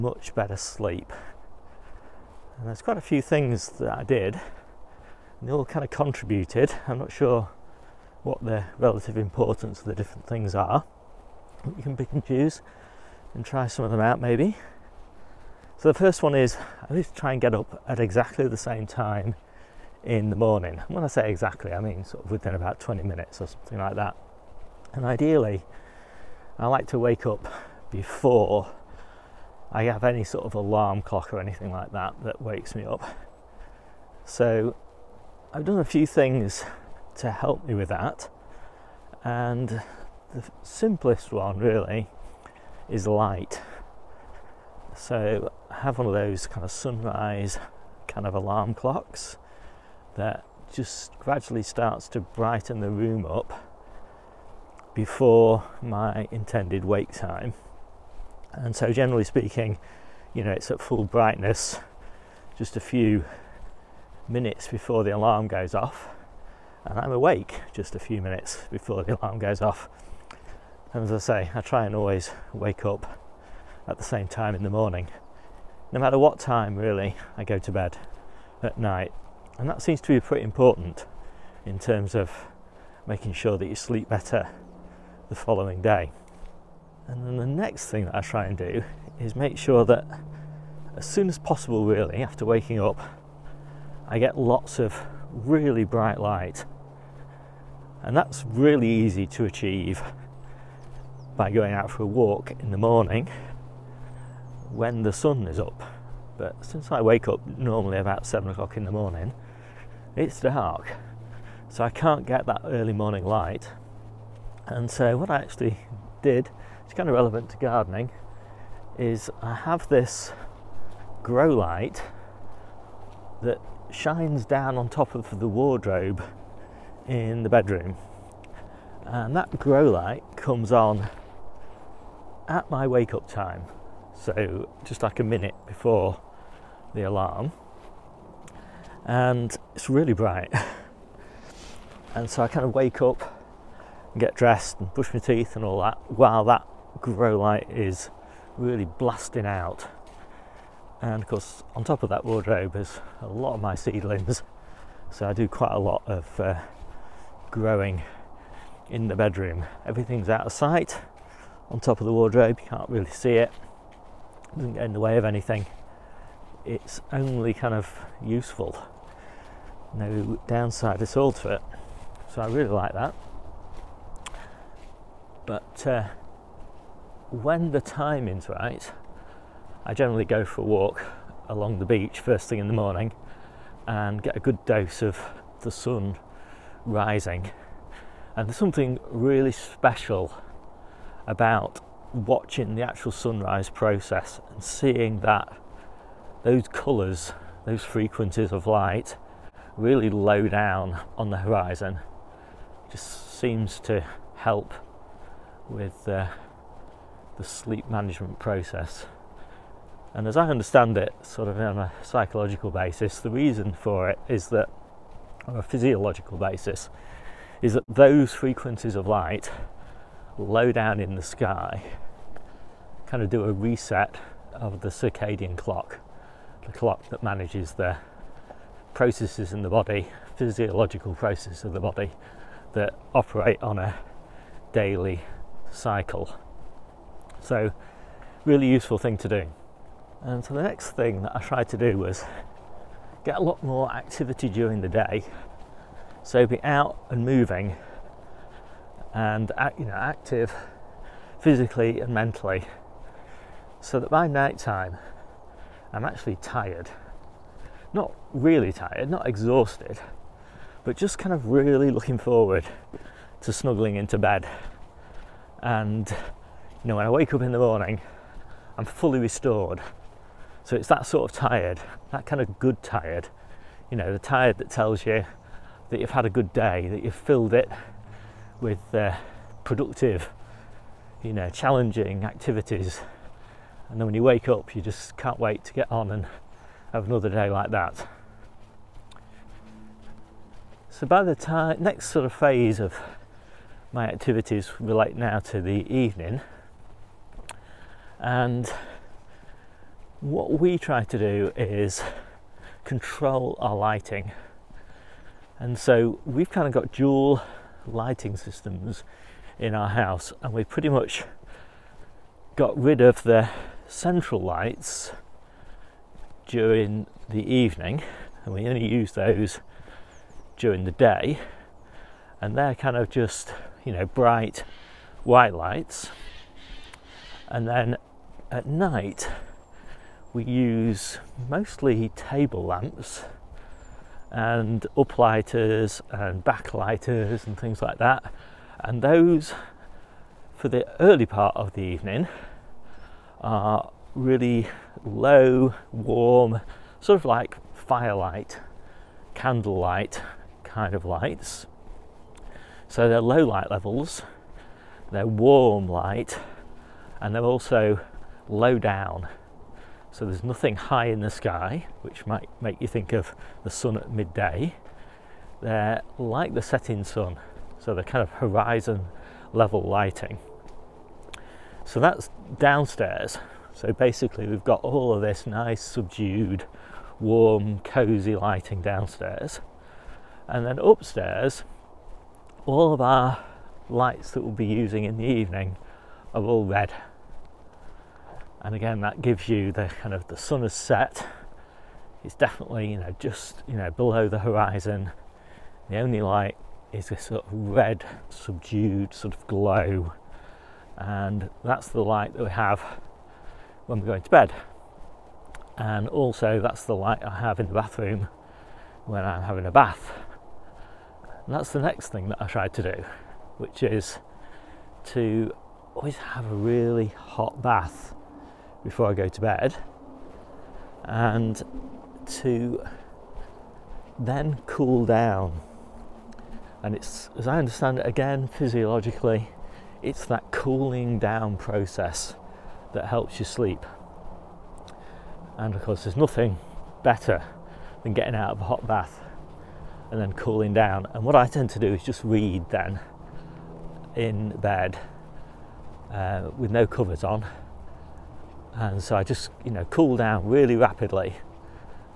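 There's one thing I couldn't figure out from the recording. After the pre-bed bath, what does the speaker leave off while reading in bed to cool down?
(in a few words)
Covers.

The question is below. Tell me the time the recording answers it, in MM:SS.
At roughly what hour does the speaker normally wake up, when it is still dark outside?
01:48.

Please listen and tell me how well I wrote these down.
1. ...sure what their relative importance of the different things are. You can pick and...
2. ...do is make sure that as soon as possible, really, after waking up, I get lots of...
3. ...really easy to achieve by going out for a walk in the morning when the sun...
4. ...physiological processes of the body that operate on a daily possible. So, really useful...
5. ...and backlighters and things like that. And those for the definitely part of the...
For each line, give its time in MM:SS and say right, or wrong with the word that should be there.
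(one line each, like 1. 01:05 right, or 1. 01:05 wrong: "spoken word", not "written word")
1. 00:07 right
2. 01:28 right
3. 01:38 right
4. 03:50 wrong: "cycle", not "possible"
5. 05:36 wrong: "early", not "definitely".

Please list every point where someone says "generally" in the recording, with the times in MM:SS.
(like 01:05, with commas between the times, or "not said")
00:58, 02:59.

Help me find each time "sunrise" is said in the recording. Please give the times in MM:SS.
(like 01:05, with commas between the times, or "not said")
00:46, 03:13.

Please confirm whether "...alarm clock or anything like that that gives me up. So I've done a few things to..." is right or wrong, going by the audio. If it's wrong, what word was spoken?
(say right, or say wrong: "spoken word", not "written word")
wrong: "wakes", not "gives".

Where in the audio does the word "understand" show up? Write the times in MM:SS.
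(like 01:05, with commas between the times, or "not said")
03:30, 07:07.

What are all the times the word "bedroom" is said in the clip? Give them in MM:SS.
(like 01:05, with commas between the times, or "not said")
02:07, 02:39.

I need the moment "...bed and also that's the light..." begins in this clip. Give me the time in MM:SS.
06:44.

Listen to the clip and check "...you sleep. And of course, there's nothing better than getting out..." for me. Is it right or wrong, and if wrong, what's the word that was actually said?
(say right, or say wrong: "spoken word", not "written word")
right.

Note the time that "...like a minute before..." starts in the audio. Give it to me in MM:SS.
02:15.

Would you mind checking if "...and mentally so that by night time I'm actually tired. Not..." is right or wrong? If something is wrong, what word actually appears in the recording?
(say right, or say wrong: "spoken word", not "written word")
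right.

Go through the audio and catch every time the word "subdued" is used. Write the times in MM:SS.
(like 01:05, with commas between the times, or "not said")
06:15, 06:38.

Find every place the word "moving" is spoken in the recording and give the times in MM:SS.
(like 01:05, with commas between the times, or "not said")
04:07.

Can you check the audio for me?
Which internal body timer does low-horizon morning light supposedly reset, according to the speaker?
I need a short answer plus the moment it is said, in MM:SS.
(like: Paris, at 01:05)
Circadian clock, at 03:44.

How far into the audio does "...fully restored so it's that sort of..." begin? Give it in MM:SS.
04:28.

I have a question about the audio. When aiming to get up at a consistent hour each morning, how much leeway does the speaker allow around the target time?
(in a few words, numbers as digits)
20 minutes.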